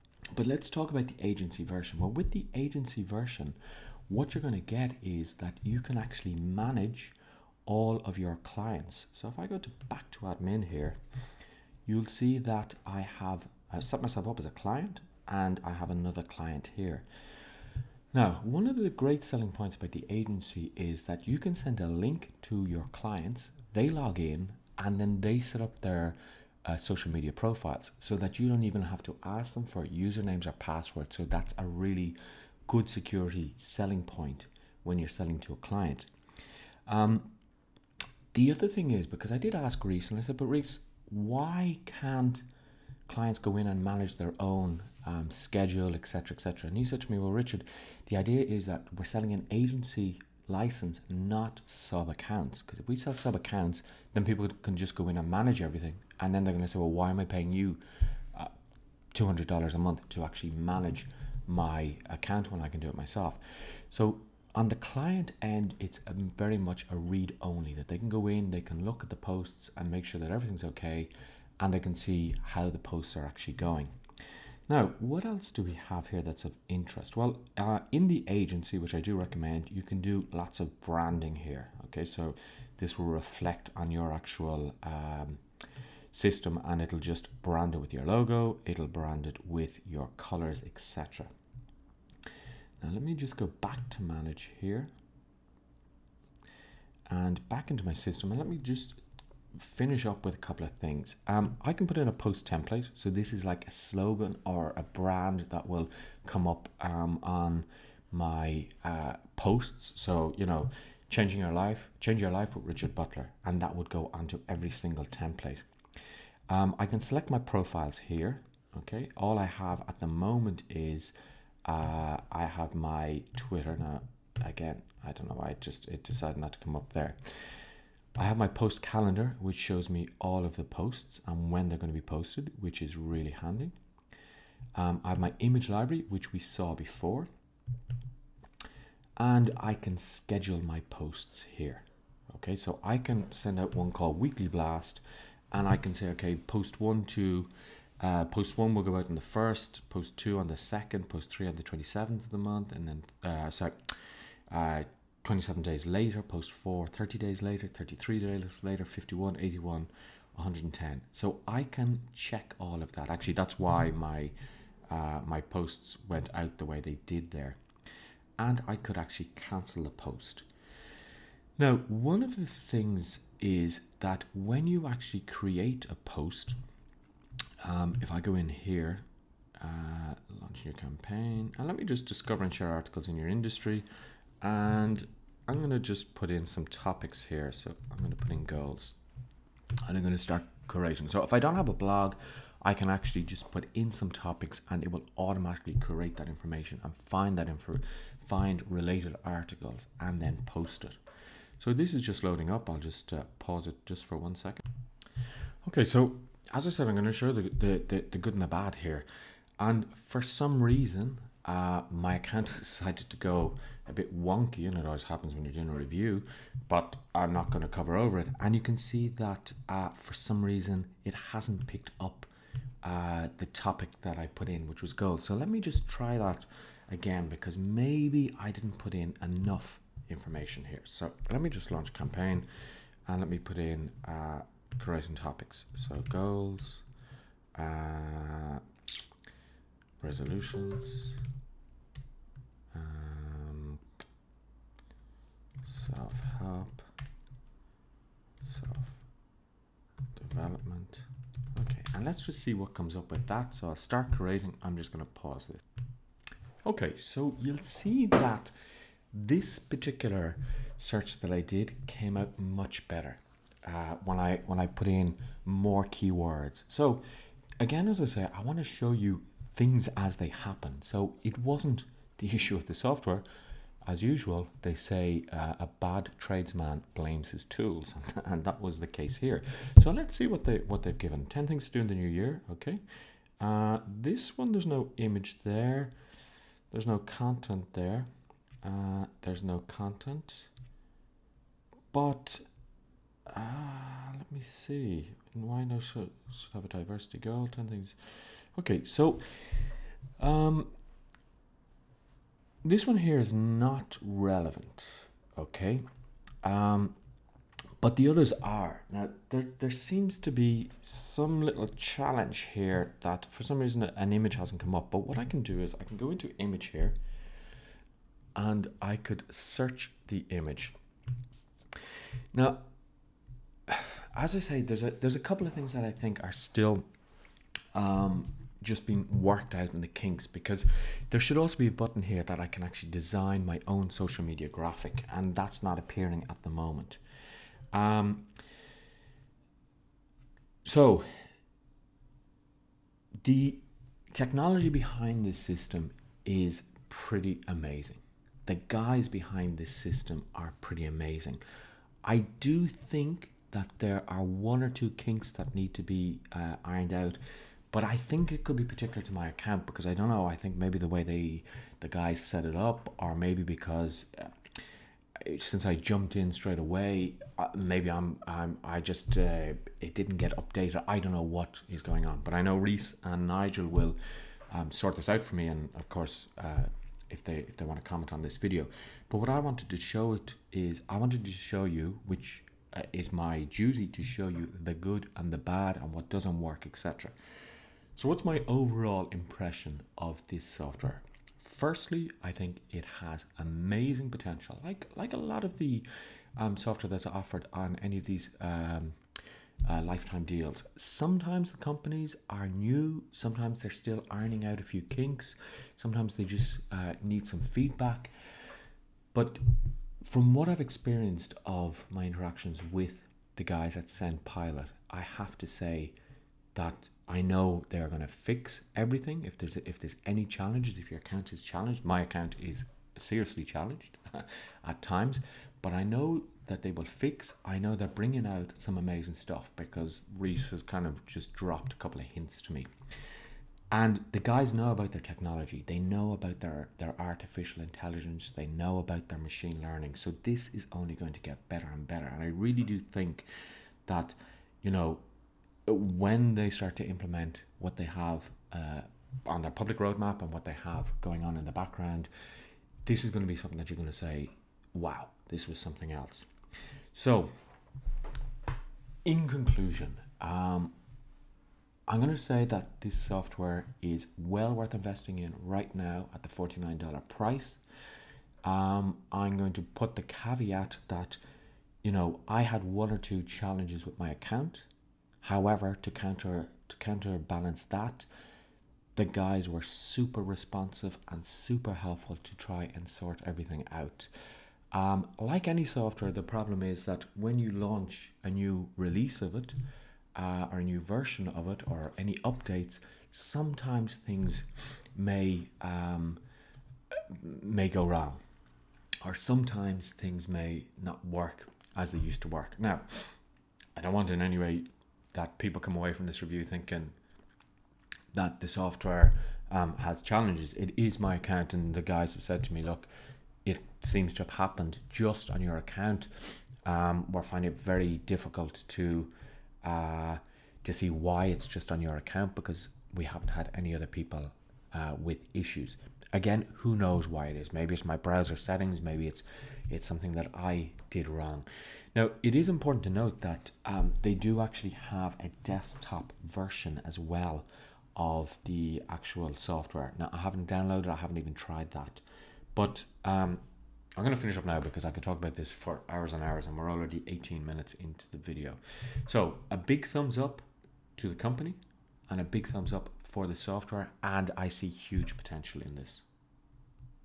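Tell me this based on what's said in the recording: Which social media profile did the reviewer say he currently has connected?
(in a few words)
Twitter.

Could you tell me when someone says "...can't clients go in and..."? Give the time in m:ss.
0:41.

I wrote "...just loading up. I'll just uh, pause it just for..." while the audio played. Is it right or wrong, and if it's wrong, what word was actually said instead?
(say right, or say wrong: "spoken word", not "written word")
right.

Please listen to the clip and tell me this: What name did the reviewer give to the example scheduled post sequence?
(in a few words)
Weekly Blast.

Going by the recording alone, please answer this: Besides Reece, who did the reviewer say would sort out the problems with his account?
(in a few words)
Nigel.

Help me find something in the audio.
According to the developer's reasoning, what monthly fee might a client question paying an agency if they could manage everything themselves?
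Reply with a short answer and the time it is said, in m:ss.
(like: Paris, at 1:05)
$200, at 0:59.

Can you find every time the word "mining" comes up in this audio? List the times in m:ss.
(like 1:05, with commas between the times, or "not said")
not said.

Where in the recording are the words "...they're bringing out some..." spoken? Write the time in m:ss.
7:07.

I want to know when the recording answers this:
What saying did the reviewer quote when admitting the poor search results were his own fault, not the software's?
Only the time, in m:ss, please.
4:35.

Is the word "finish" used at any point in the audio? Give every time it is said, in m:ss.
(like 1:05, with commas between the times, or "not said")
1:39, 9:04.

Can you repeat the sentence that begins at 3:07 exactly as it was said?
So I'm going to put in goals and I'm going to start curating.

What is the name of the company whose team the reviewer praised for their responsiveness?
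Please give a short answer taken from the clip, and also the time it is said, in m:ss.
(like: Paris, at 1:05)
SendPilot, at 6:53.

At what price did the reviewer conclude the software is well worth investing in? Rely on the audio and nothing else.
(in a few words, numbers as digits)
$49.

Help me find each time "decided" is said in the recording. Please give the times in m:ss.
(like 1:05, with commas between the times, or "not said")
2:06, 3:32.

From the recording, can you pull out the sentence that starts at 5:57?
But I think it could be particular to my account because I don't know.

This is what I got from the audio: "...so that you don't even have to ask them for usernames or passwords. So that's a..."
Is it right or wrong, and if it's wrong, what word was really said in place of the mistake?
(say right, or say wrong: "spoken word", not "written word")
right.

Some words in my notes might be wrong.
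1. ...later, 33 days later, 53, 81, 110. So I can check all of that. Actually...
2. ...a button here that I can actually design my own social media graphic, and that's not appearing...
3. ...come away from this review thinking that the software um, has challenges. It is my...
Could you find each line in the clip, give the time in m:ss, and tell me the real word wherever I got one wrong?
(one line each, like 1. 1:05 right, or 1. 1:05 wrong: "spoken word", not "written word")
1. 2:37 wrong: "51", not "53"
2. 5:31 right
3. 8:25 right.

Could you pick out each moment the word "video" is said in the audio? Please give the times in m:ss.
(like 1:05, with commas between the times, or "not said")
6:18, 9:08.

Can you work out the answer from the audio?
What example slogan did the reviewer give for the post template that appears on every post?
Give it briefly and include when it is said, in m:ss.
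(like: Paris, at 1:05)
Change your life with Richard Butler, at 1:52.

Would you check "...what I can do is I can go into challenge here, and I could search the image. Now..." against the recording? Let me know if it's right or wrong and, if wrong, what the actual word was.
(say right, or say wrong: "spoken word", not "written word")
wrong: "image", not "challenge".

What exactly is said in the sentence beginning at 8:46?
Again, who knows why it is?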